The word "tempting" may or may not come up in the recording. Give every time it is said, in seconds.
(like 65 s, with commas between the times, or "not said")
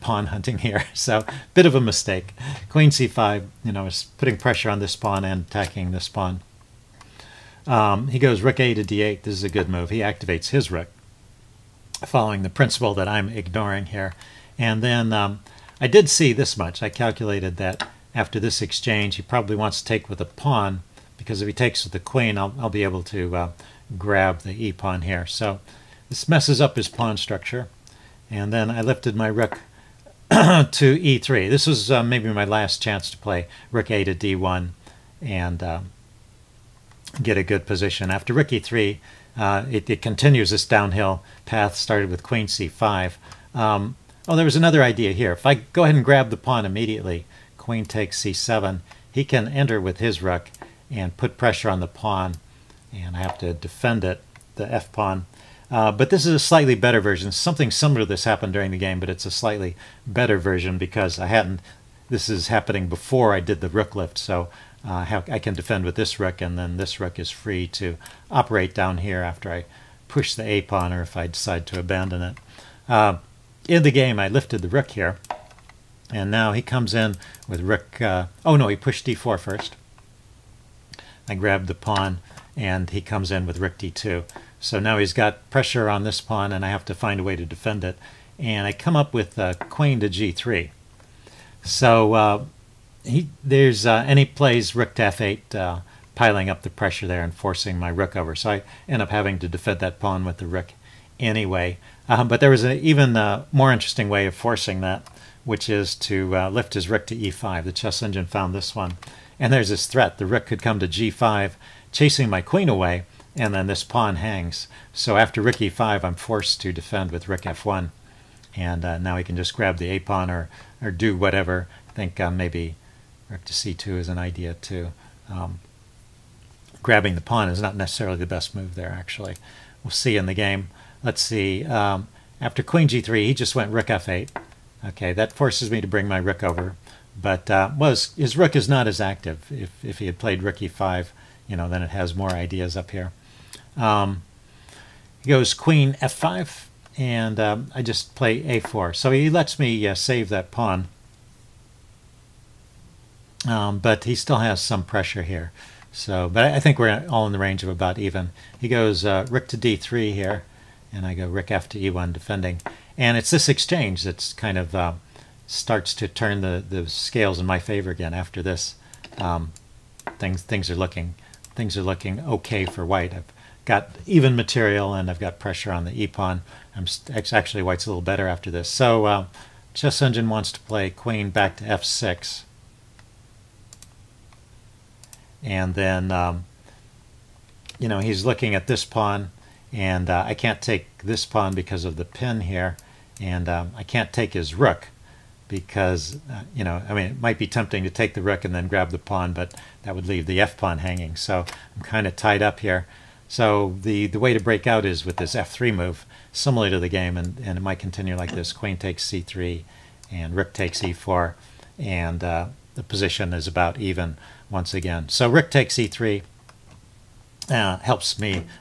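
197 s.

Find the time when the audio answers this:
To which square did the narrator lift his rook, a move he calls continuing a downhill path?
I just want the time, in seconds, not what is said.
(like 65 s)
30 s.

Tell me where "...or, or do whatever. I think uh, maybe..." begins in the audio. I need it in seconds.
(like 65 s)
120 s.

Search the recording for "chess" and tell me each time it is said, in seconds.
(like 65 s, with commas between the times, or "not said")
107 s, 179 s.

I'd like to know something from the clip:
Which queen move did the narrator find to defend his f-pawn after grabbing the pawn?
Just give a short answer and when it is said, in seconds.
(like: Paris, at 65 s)
Queen to g3, at 89 s.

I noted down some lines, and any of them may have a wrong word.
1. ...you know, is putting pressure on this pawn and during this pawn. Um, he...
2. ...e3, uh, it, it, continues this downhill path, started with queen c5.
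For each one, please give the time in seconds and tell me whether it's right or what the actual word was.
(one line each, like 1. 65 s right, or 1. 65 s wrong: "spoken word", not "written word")
1. 3 s wrong: "attacking", not "during"
2. 38 s right.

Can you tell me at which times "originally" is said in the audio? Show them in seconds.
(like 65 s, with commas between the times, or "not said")
not said.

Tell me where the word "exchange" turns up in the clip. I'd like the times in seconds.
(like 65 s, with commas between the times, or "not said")
18 s, 163 s.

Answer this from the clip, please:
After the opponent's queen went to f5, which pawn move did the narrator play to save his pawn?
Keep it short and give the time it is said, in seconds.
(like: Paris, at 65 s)
a4, at 148 s.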